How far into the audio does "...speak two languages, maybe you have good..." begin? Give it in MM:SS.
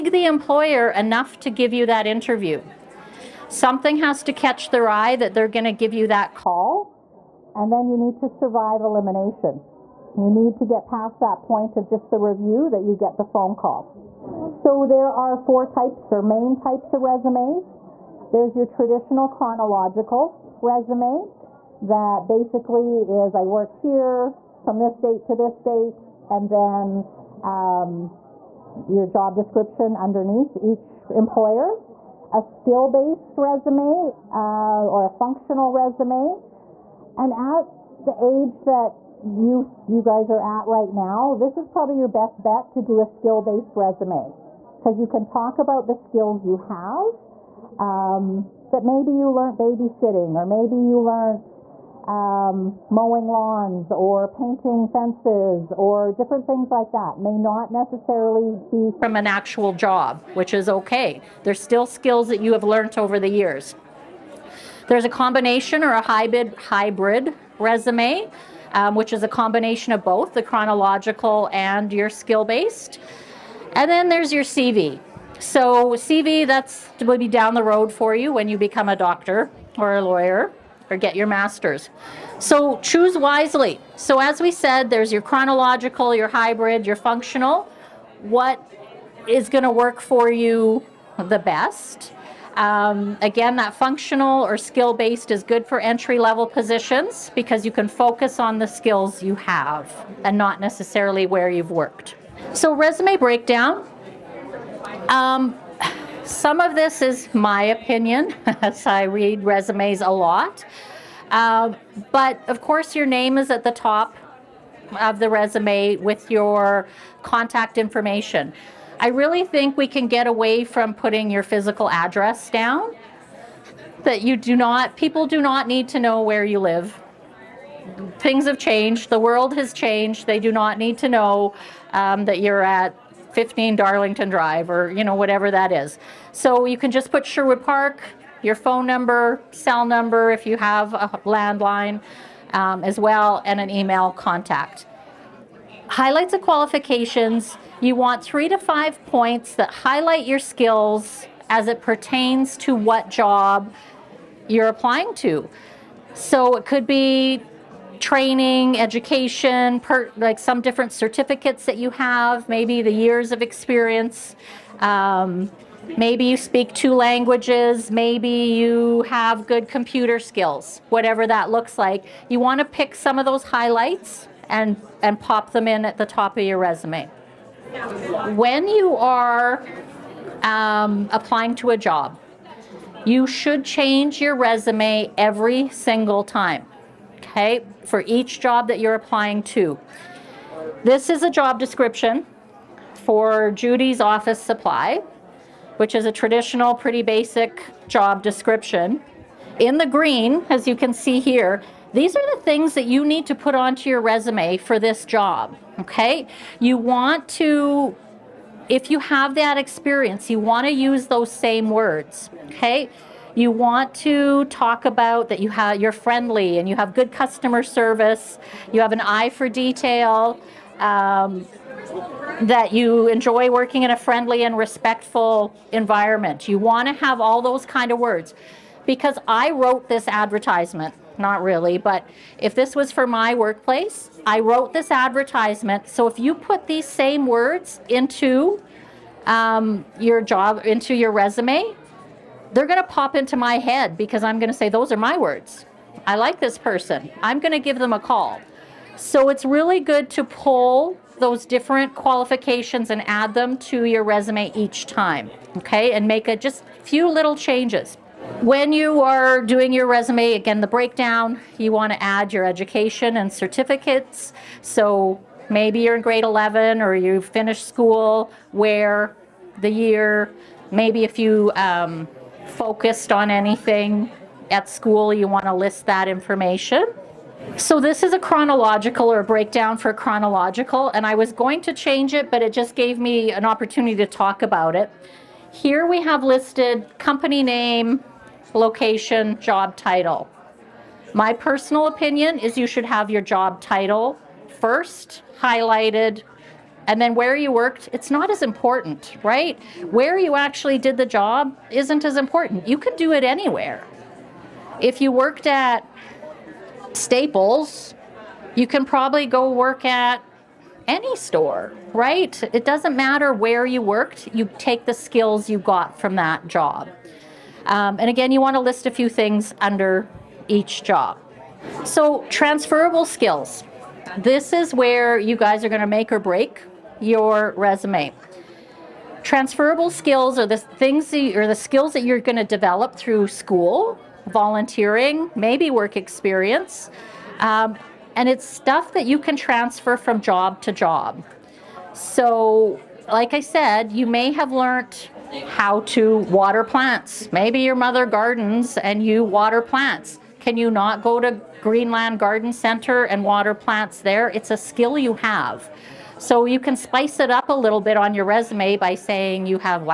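02:46.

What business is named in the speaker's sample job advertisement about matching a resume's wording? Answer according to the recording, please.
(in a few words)
Judy's office supply.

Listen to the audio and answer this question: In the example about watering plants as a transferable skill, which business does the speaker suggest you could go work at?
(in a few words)
Greenland Garden Center.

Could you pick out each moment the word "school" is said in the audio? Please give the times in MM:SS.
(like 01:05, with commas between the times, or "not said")
04:27, 04:34, 05:33.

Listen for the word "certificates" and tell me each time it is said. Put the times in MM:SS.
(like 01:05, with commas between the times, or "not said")
02:40, 04:23.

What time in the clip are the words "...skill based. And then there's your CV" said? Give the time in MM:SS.
01:12.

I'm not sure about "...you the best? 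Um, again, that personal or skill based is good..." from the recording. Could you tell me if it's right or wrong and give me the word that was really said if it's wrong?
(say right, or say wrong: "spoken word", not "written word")
wrong: "functional", not "personal".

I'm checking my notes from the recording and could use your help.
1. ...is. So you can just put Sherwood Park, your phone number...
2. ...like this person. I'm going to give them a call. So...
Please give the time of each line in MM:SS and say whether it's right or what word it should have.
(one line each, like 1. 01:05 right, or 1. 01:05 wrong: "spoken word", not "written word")
1. 02:15 right
2. 04:06 right.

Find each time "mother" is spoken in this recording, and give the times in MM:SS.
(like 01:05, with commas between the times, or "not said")
05:47.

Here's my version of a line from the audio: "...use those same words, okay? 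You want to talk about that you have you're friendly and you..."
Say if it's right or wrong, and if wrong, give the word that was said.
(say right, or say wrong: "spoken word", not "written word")
right.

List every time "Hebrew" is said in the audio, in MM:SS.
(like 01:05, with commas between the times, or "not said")
not said.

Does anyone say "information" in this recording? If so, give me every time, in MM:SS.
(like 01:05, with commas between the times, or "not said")
01:57, 04:36.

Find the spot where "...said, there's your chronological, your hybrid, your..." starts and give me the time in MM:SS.
01:24.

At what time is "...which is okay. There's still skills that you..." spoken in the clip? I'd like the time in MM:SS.
01:00.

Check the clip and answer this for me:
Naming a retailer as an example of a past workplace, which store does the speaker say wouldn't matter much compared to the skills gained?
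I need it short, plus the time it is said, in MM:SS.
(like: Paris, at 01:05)
Staples, at 05:06.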